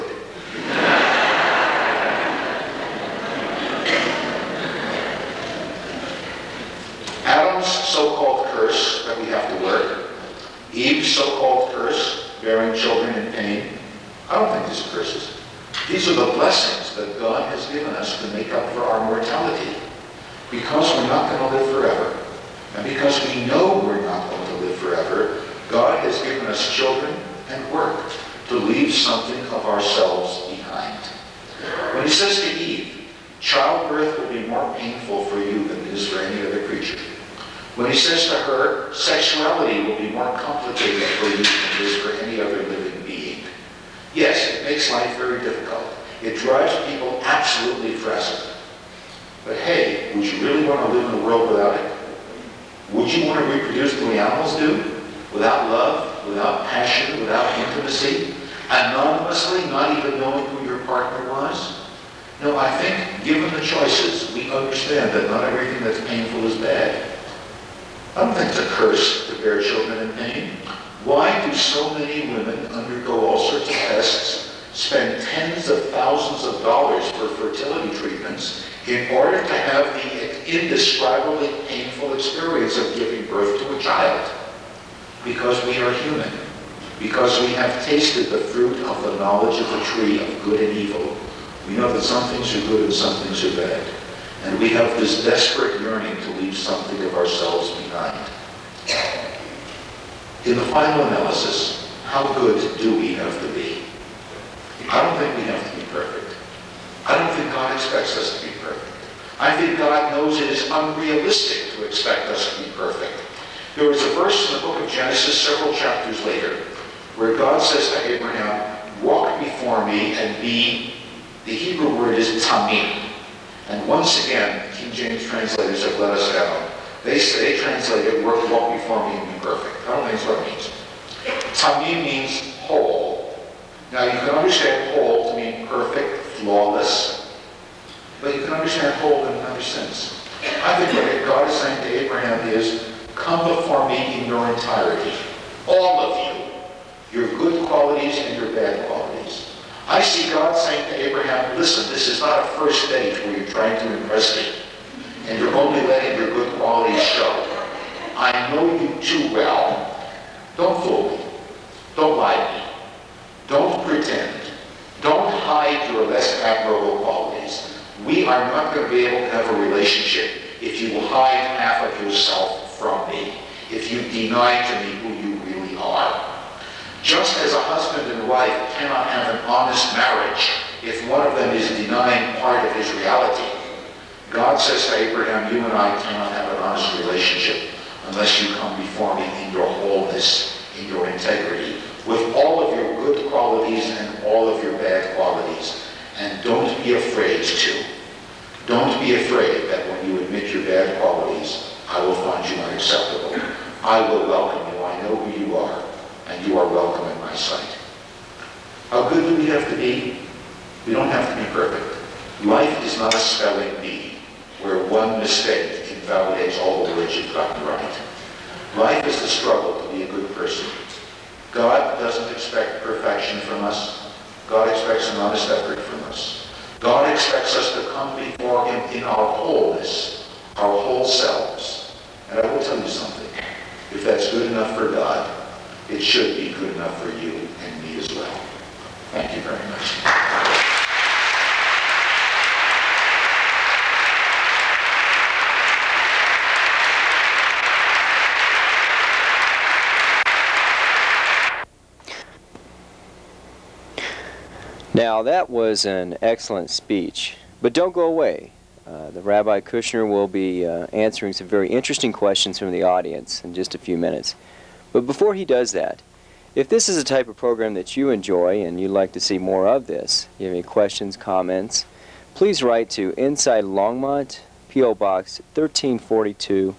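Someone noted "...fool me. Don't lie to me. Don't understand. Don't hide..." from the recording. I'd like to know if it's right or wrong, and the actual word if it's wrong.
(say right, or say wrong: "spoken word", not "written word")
wrong: "pretend", not "understand".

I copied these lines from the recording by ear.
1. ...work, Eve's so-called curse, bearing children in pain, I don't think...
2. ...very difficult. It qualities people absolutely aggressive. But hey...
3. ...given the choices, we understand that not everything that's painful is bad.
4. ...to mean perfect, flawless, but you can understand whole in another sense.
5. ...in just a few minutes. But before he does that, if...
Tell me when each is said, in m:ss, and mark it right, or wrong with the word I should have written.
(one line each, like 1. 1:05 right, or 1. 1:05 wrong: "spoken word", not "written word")
1. 0:09 right
2. 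0:45 wrong: "drives", not "qualities"
3. 1:03 right
4. 2:15 right
5. 4:23 right.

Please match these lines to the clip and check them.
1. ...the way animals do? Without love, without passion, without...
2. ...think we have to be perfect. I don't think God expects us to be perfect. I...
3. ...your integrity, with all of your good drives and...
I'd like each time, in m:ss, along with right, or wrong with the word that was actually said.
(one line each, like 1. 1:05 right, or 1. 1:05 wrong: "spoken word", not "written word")
1. 0:53 right
2. 1:45 right
3. 3:10 wrong: "qualities", not "drives".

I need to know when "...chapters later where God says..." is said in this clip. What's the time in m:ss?
1:55.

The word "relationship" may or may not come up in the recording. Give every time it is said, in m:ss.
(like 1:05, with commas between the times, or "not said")
2:49, 3:06.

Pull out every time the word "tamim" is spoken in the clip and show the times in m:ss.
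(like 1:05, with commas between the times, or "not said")
2:02, 2:12.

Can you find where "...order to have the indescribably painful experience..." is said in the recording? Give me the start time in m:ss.
1:19.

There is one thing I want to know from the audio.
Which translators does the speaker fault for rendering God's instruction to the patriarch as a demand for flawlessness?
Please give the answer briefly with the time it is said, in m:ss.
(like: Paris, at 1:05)
King James translators, at 2:04.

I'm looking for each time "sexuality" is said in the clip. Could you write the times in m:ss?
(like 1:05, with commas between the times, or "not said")
0:38.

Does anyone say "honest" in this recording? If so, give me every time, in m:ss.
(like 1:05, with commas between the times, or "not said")
2:59, 3:06, 3:45.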